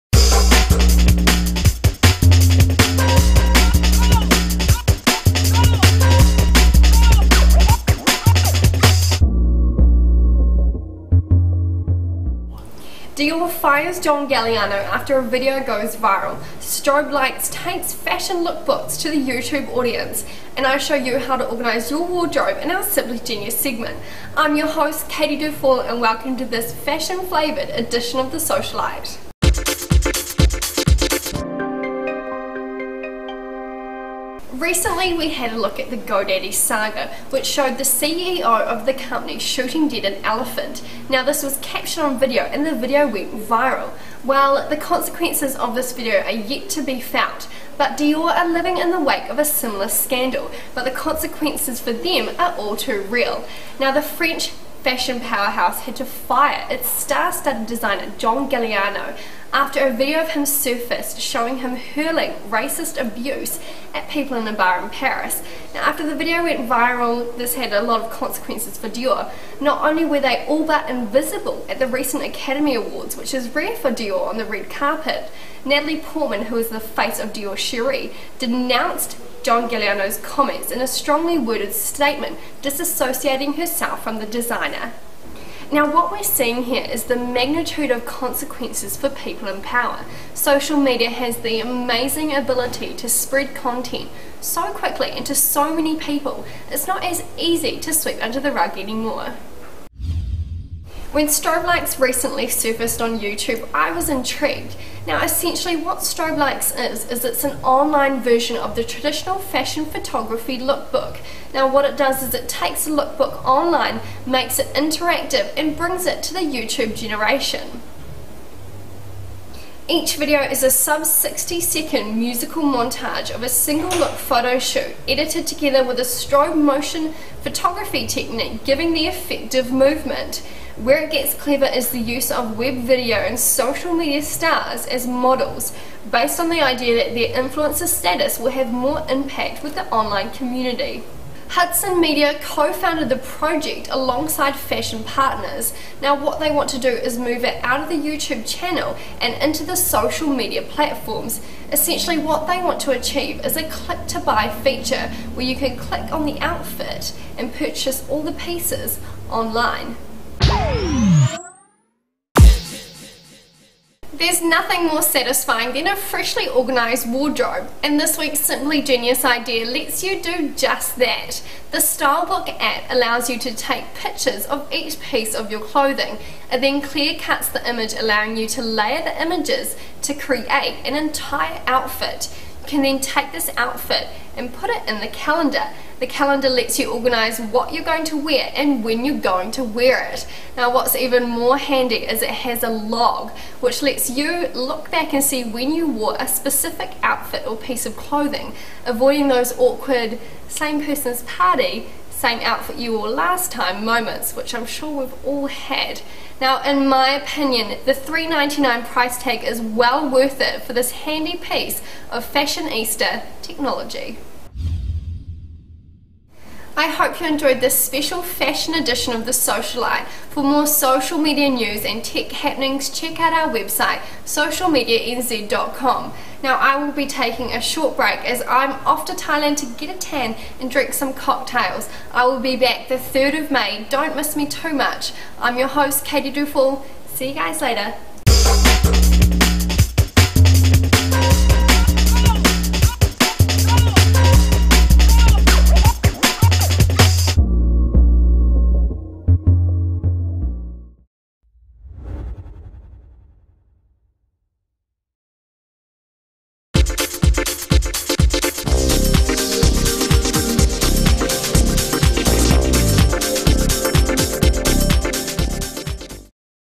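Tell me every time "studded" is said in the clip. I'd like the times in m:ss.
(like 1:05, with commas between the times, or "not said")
0:56.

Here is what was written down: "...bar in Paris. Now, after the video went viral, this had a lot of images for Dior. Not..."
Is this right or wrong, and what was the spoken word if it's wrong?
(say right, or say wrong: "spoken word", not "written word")
wrong: "consequences", not "images".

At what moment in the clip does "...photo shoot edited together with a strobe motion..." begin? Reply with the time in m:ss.
2:04.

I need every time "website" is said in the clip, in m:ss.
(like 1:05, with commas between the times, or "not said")
3:43.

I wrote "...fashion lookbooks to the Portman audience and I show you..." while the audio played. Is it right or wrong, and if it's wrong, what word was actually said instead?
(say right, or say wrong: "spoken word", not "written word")
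wrong: "YouTube", not "Portman".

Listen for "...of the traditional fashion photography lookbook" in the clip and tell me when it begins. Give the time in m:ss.
1:48.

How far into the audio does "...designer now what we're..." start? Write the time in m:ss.
1:24.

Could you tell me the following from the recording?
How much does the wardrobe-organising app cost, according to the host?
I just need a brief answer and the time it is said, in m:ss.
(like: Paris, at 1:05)
$3.99, at 3:27.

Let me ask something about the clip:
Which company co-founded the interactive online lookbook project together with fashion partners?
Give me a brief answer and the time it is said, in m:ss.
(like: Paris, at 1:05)
Hudson Media, at 2:21.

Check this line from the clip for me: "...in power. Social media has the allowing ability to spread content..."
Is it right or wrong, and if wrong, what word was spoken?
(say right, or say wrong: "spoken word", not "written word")
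wrong: "amazing", not "allowing".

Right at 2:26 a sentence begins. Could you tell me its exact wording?
Now what they want to do is move it out of the YouTube channel and into the social media platforms.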